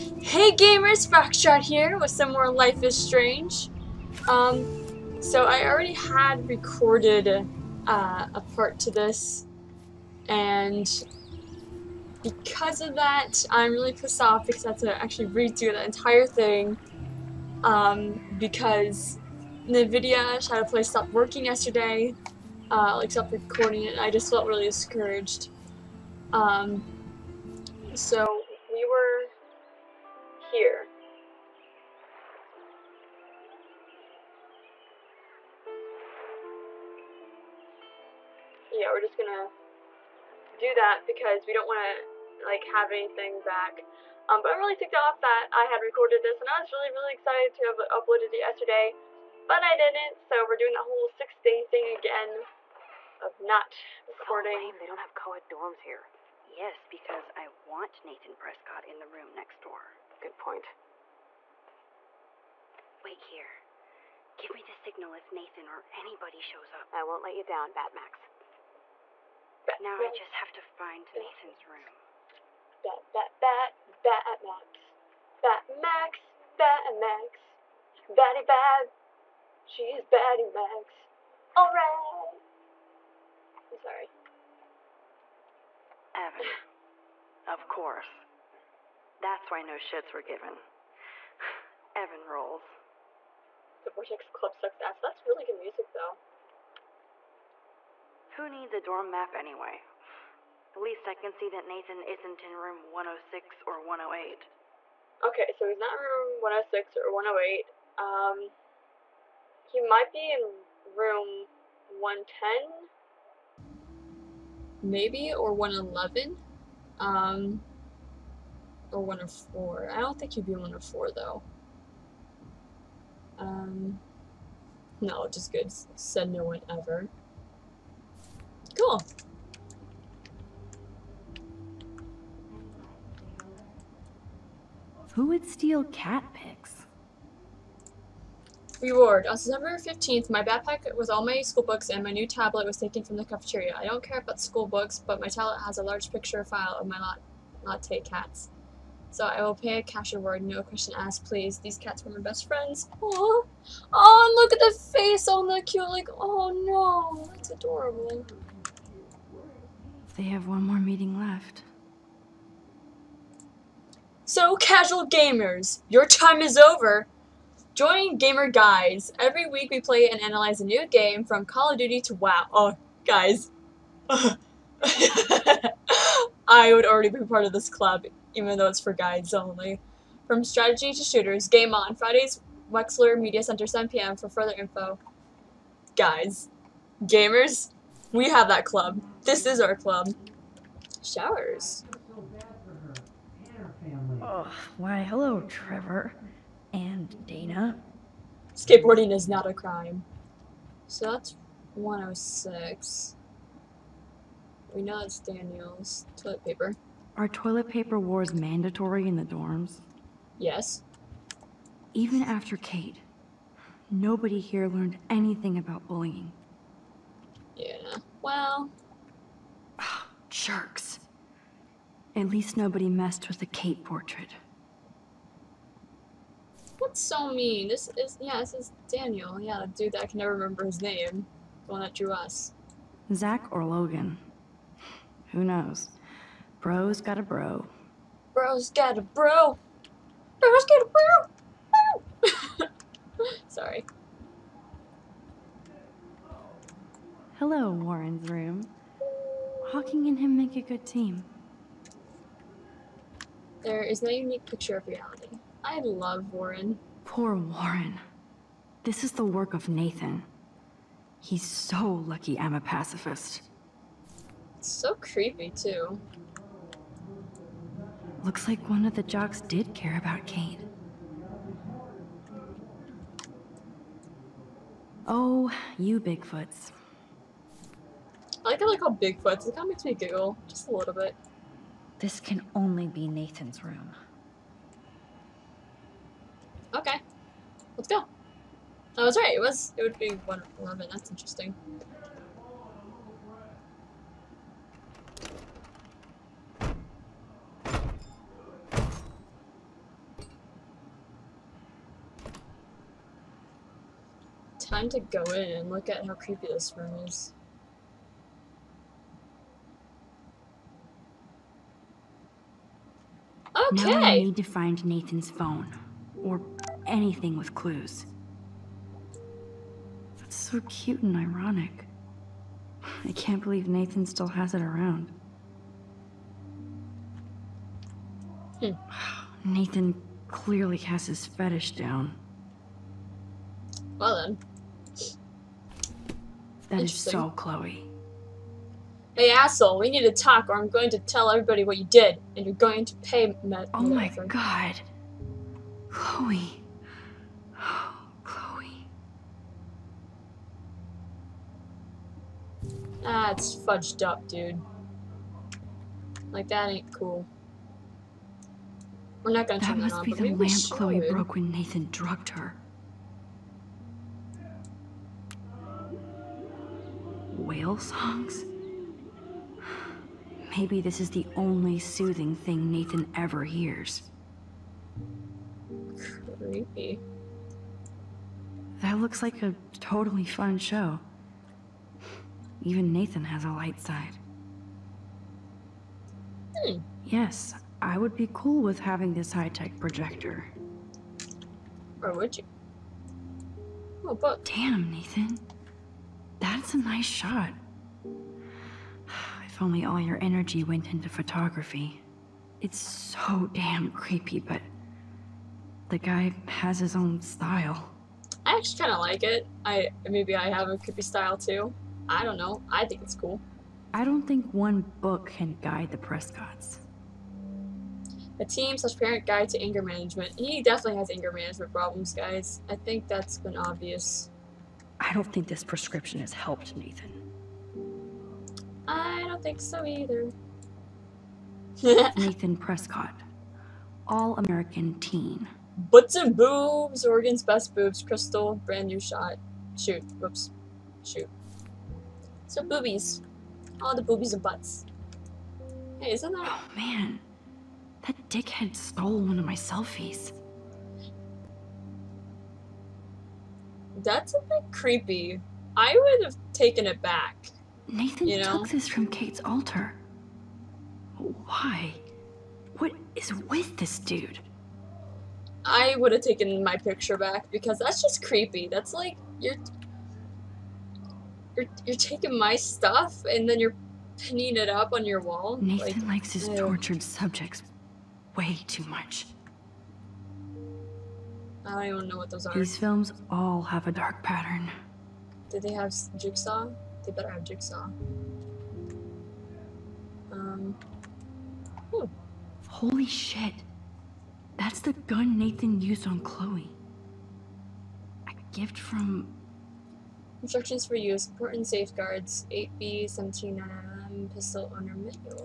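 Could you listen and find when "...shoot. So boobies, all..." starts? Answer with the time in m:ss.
7:21.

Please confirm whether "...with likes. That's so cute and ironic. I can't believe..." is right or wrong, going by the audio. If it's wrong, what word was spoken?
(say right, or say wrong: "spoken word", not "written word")
wrong: "clues", not "likes".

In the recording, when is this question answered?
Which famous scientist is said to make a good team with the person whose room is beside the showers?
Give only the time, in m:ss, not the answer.
4:09.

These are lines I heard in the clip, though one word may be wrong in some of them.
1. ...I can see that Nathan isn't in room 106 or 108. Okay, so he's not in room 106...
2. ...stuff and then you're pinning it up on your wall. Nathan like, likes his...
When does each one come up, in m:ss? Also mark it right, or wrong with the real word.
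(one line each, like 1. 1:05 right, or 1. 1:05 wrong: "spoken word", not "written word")
1. 1:41 right
2. 7:52 right.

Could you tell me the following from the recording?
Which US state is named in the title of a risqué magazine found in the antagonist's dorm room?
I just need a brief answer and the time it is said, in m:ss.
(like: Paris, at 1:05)
Oregon, at 7:17.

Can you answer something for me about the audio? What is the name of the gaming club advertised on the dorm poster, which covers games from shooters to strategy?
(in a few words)
Gamer Guys.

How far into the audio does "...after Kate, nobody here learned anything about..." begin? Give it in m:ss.
3:32.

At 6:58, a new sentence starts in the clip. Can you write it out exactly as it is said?
A team slash parent guide to anger management.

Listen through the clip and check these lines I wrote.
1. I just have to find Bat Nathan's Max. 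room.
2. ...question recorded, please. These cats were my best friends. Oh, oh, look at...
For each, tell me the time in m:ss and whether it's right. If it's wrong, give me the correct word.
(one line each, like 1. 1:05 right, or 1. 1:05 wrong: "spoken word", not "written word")
1. 1:10 right
2. 2:30 wrong: "asked", not "recorded".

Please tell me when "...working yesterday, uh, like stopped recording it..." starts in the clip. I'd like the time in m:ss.
0:21.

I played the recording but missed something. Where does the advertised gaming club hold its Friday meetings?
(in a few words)
Wexler Media Center.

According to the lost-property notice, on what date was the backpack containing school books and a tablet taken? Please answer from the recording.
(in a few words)
September 15th.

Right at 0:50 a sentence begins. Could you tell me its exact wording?
So we're doing that whole six day thing again of not recording.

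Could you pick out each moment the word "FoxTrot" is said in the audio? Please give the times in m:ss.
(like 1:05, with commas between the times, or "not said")
0:01.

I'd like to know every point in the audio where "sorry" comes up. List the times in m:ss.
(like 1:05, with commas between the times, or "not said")
1:23, 4:03.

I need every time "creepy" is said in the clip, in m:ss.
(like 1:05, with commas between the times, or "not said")
4:24, 5:06, 6:16, 6:43, 6:50, 7:34, 7:48.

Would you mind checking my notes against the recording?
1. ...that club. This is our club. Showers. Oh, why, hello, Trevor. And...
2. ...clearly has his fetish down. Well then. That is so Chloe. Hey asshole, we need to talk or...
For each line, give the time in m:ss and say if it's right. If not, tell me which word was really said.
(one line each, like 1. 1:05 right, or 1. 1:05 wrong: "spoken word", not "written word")
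1. 3:08 right
2. 5:30 right.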